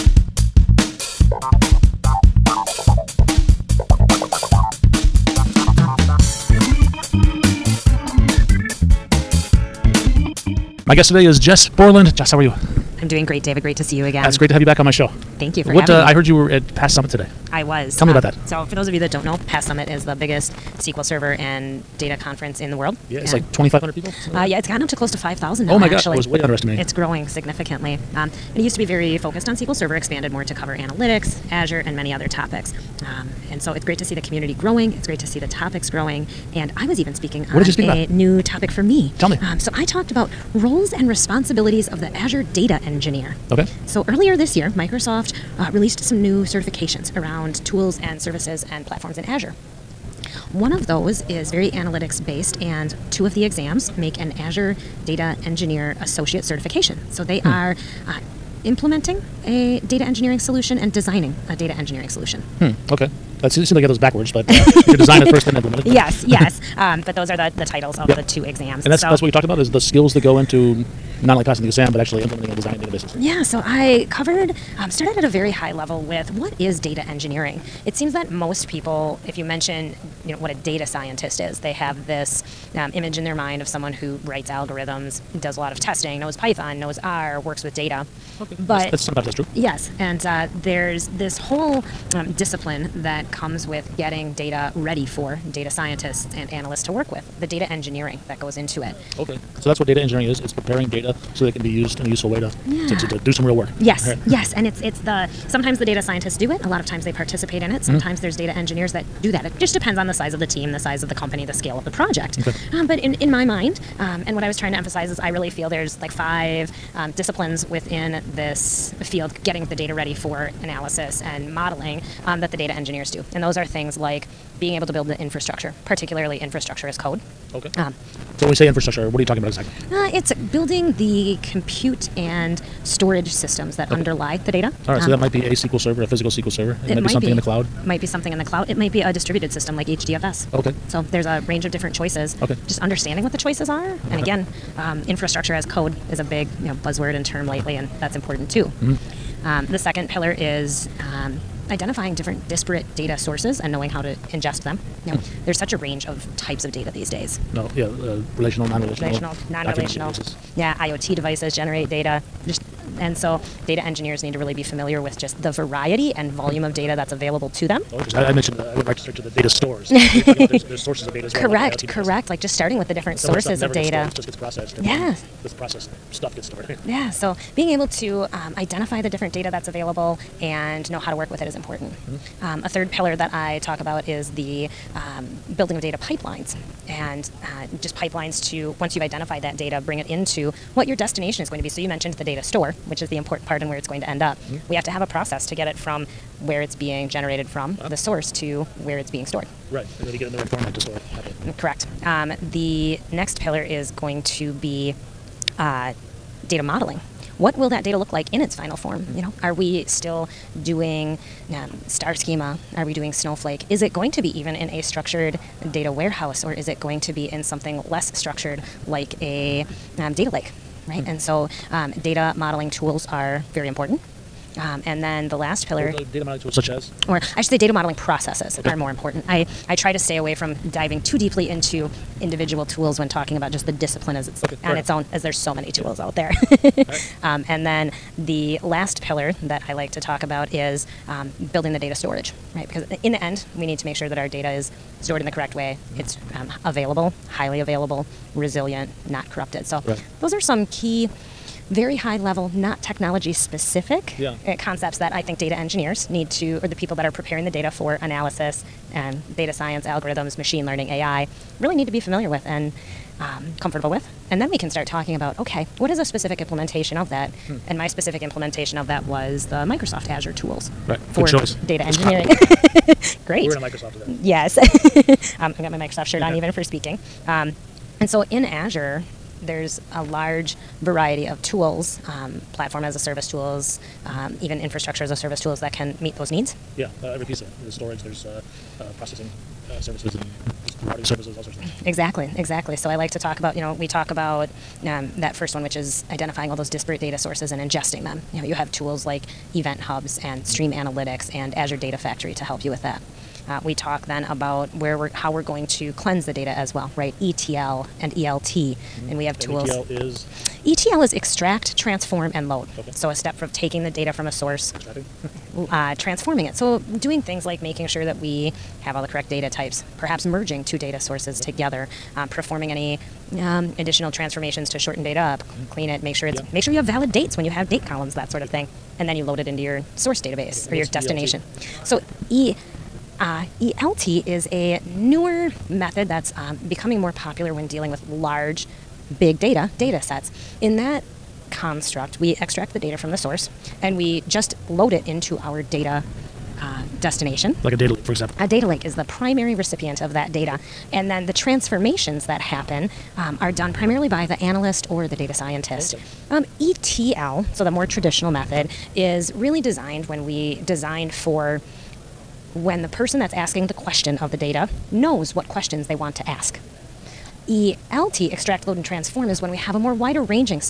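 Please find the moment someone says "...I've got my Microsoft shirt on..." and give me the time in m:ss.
4:35.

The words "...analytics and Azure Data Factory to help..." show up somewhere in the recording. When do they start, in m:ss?
5:00.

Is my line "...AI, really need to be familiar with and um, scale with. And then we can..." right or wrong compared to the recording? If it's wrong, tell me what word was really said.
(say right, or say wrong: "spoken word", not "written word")
wrong: "comfortable", not "scale".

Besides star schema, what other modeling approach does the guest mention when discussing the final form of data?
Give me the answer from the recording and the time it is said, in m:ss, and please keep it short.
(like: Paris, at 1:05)
Snowflake, at 3:33.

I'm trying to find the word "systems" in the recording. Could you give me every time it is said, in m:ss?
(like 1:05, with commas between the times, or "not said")
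2:13, 2:19.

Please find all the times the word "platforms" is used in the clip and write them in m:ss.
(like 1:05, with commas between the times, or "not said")
0:48, 4:42.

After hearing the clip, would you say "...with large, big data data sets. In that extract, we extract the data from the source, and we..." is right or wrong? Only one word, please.
wrong.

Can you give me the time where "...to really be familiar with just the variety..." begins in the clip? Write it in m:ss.
2:44.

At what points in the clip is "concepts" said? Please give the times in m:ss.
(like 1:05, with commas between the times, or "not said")
4:14.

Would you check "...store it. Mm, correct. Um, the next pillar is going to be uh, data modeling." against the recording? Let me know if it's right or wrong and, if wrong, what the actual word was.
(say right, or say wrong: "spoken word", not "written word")
right.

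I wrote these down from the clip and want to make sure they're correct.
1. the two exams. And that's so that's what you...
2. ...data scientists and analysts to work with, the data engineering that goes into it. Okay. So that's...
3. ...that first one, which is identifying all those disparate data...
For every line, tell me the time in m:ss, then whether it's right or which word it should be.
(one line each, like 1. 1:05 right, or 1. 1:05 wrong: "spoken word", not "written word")
1. 1:08 right
2. 1:35 right
3. 4:55 right.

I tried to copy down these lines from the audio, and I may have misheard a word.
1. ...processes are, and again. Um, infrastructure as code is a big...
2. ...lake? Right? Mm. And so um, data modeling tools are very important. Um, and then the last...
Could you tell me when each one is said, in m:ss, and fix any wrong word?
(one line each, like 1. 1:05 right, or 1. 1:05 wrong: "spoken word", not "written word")
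1. 2:23 wrong: "choices", not "processes"
2. 3:40 right.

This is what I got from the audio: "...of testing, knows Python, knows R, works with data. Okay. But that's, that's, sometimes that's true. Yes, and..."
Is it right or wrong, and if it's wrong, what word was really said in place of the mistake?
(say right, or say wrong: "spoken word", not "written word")
right.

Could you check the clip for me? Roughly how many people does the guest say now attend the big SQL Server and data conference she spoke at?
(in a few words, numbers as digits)
5,000.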